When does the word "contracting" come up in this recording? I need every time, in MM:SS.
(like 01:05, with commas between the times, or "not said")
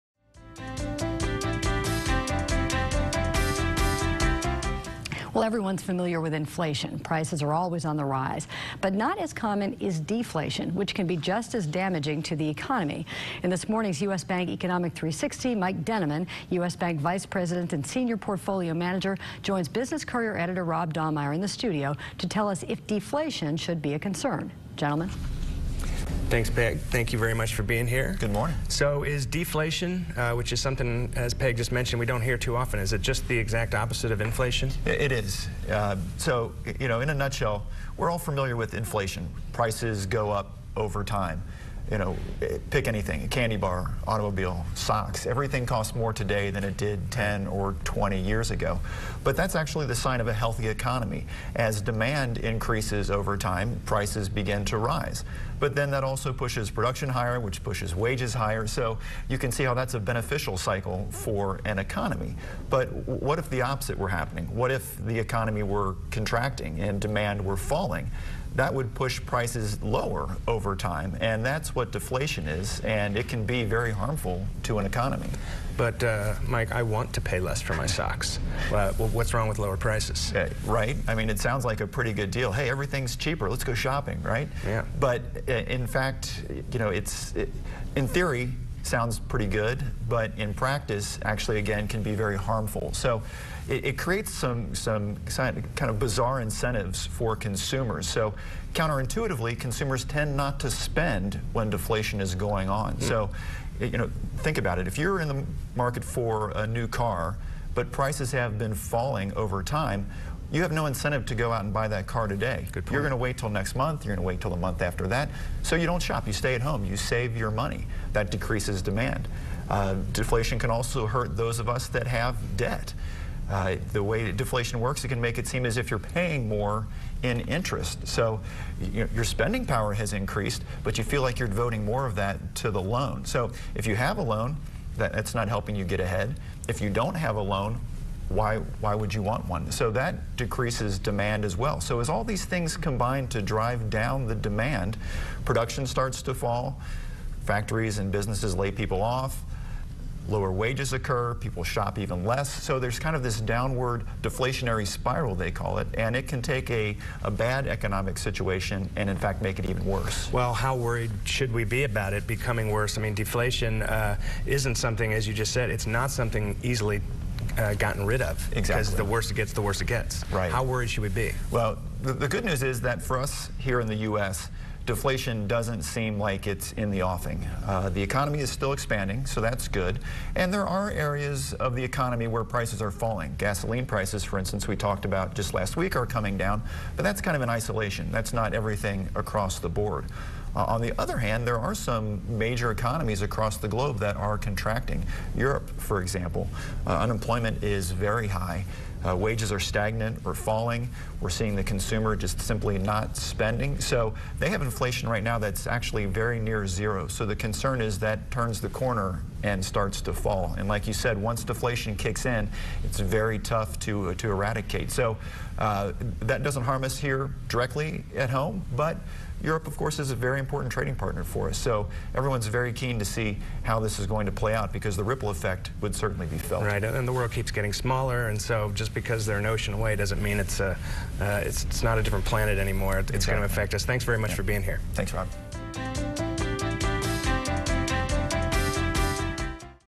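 01:06, 03:14.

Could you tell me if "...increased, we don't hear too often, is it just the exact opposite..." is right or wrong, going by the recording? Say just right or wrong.
wrong.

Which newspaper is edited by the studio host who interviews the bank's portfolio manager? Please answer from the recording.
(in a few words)
Business Courier.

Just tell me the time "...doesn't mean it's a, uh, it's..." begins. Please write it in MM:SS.
03:49.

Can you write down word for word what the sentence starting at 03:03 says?
Gasoline prices, for instance, we talked about just last week are coming down, but that's kind of in isolation.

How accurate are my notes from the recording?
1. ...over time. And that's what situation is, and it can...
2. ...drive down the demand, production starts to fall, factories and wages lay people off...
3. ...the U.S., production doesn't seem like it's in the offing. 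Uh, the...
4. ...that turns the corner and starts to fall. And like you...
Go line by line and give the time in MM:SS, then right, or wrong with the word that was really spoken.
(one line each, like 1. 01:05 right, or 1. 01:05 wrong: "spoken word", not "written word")
1. 01:10 wrong: "deflation", not "situation"
2. 02:23 wrong: "businesses", not "wages"
3. 02:53 wrong: "deflation", not "production"
4. 03:27 right.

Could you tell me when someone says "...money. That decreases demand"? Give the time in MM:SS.
01:57.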